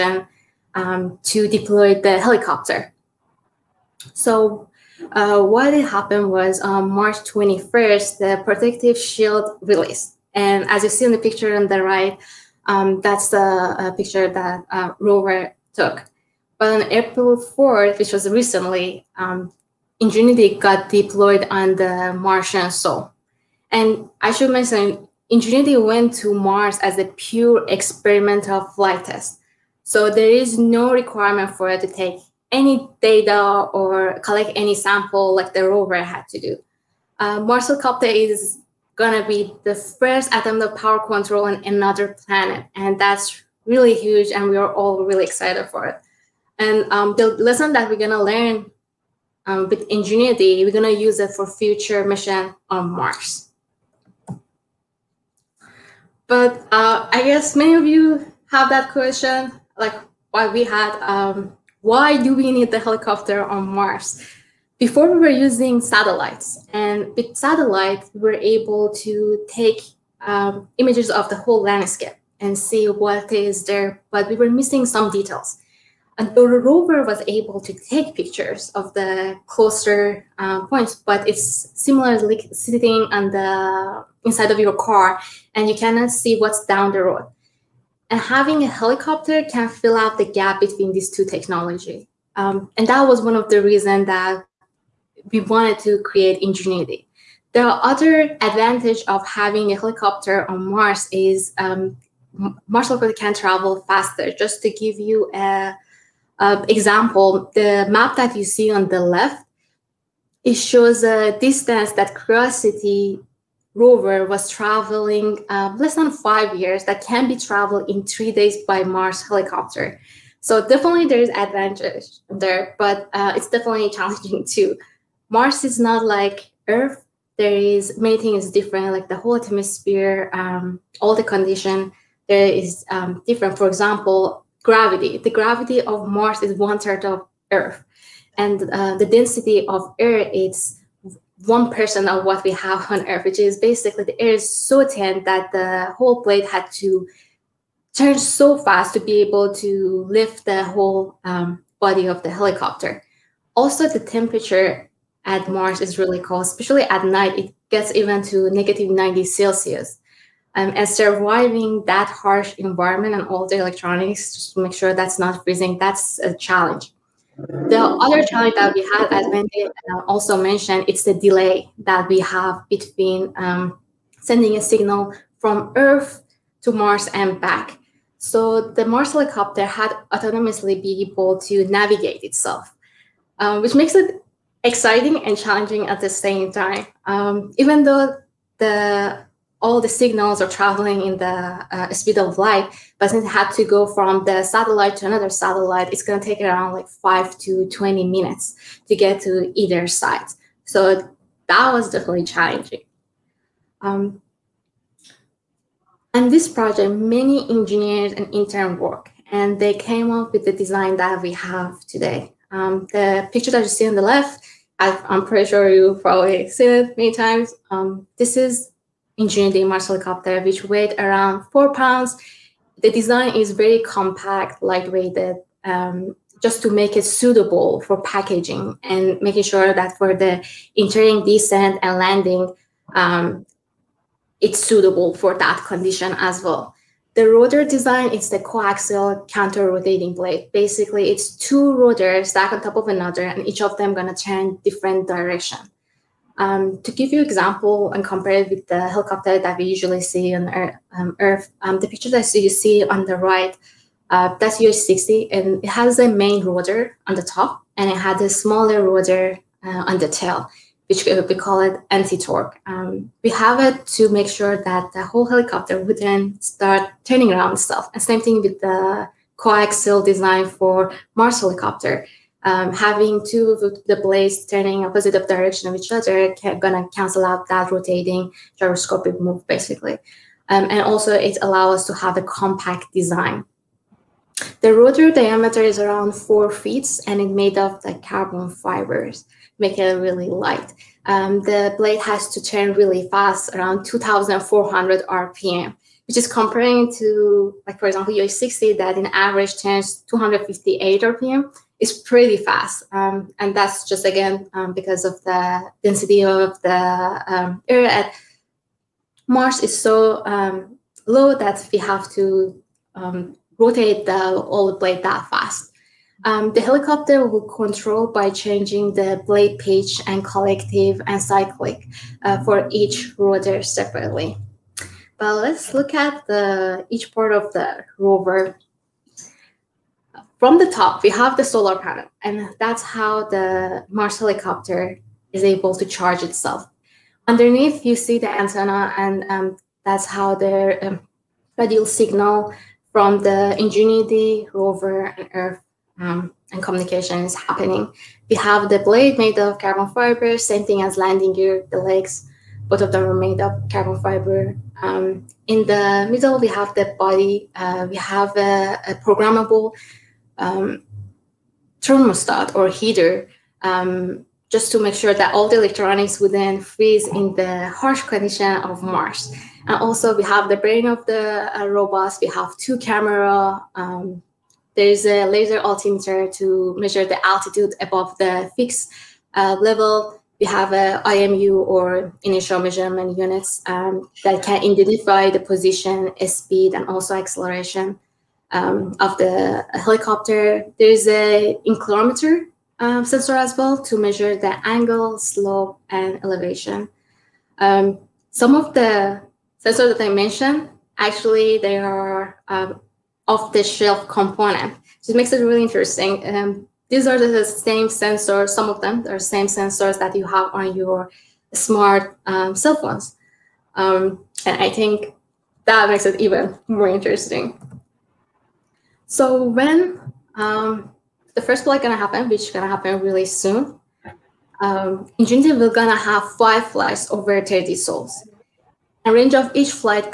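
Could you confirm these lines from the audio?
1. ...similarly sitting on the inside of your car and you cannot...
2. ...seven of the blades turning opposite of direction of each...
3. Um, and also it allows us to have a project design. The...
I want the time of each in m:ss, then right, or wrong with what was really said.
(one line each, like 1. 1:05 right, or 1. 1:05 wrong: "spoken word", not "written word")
1. 1:21 right
2. 4:33 wrong: "two", not "seven"
3. 4:40 wrong: "compact", not "project".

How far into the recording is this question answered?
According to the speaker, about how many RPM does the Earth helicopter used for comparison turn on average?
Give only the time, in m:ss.
5:00.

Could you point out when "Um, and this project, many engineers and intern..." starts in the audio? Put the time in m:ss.
3:23.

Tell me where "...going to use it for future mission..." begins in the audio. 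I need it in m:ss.
0:50.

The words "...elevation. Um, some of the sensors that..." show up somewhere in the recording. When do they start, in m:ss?
6:36.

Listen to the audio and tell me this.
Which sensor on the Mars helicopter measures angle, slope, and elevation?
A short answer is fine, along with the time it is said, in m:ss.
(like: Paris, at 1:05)
inclinometer, at 6:31.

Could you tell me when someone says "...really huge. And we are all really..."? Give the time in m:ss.
0:43.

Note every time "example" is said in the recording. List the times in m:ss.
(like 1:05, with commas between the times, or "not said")
1:46, 2:13, 4:07, 4:57.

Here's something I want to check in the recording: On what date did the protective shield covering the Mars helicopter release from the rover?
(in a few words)
March 21st.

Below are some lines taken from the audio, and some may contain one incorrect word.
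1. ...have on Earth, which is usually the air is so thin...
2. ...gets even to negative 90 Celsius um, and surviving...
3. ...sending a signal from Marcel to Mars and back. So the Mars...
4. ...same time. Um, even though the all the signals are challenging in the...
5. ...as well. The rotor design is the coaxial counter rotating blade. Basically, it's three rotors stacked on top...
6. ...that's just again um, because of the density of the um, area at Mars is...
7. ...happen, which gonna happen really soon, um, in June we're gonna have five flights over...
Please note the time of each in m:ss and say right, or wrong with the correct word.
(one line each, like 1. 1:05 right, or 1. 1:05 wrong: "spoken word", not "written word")
1. 2:22 wrong: "basically", not "usually"
2. 2:37 right
3. 2:54 wrong: "Earth", not "Marcel"
4. 3:06 wrong: "traveling", not "challenging"
5. 3:56 wrong: "two", not "three"
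6. 5:03 right
7. 7:01 right.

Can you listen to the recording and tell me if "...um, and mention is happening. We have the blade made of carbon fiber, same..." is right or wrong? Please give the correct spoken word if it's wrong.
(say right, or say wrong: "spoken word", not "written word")
wrong: "communication", not "mention".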